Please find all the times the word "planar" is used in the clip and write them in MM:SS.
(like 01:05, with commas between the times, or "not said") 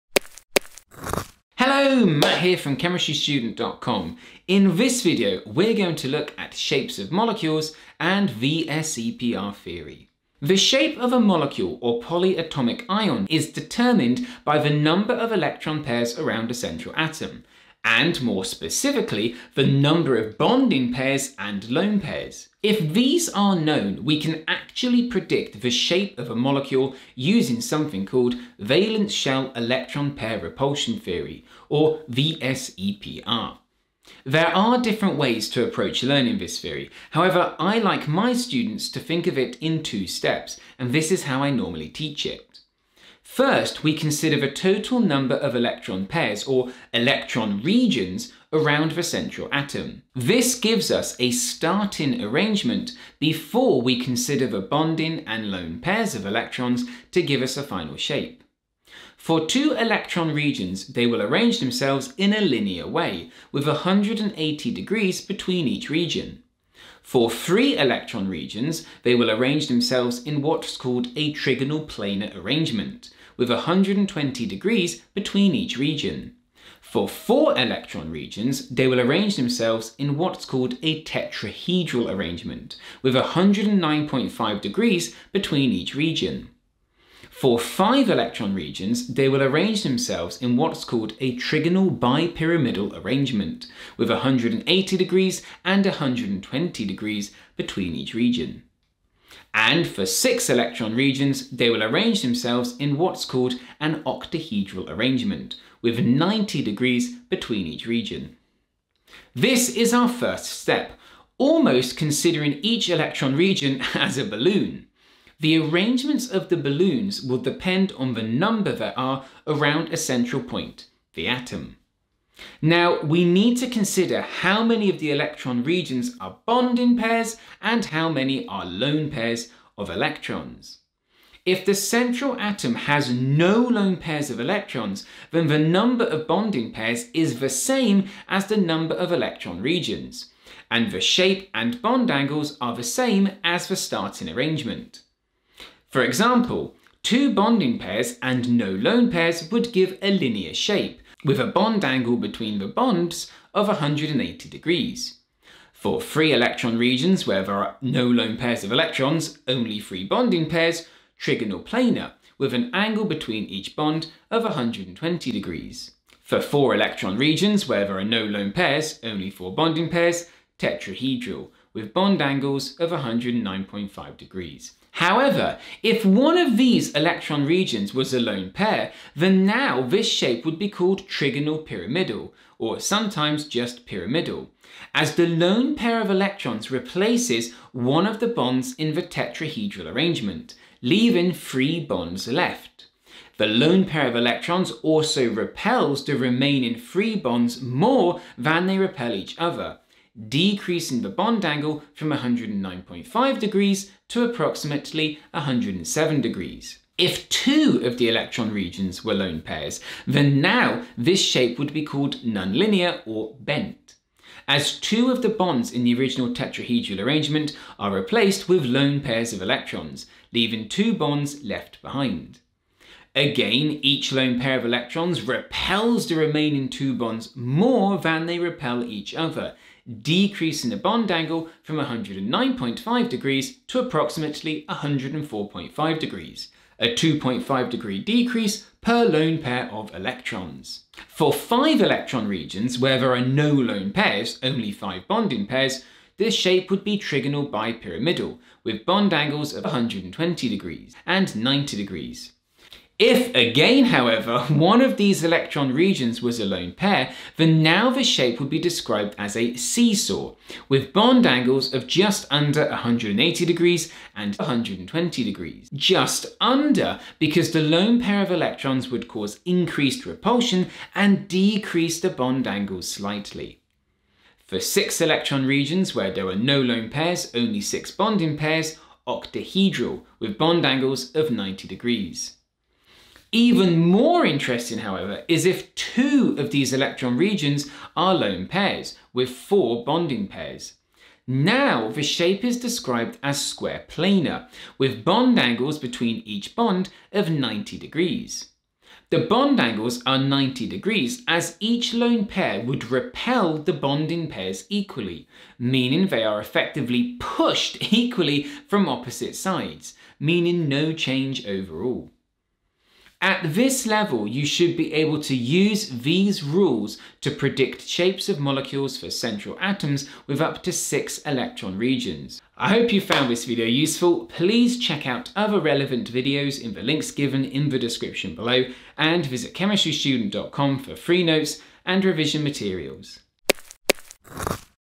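01:11, 02:41, 04:53.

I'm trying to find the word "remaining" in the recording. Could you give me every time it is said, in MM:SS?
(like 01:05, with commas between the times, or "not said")
03:16, 03:46.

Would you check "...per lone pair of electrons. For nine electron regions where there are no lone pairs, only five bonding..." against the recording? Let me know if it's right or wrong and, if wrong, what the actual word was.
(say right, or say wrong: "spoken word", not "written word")
wrong: "five", not "nine".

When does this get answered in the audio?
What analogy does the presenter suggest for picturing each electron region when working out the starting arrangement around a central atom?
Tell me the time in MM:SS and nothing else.
01:54.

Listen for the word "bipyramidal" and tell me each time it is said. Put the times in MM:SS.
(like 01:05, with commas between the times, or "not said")
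01:31, 04:07.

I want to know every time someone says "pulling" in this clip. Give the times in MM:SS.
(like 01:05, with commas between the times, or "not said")
not said.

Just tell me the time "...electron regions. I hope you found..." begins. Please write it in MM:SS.
05:21.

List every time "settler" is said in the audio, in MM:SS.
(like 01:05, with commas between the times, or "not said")
not said.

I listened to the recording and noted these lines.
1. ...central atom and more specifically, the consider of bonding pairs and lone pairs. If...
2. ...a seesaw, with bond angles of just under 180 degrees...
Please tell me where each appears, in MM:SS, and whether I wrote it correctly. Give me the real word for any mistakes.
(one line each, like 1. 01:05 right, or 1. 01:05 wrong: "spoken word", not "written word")
1. 00:16 wrong: "number", not "consider"
2. 04:19 right.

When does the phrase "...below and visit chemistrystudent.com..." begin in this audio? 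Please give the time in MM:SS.
05:28.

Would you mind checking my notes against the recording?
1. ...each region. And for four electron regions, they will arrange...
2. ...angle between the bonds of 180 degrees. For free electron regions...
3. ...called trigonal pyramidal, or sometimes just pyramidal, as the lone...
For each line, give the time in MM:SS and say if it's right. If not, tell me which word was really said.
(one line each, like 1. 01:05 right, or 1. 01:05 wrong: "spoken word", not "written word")
1. 01:37 wrong: "six", not "four"
2. 02:31 right
3. 03:00 right.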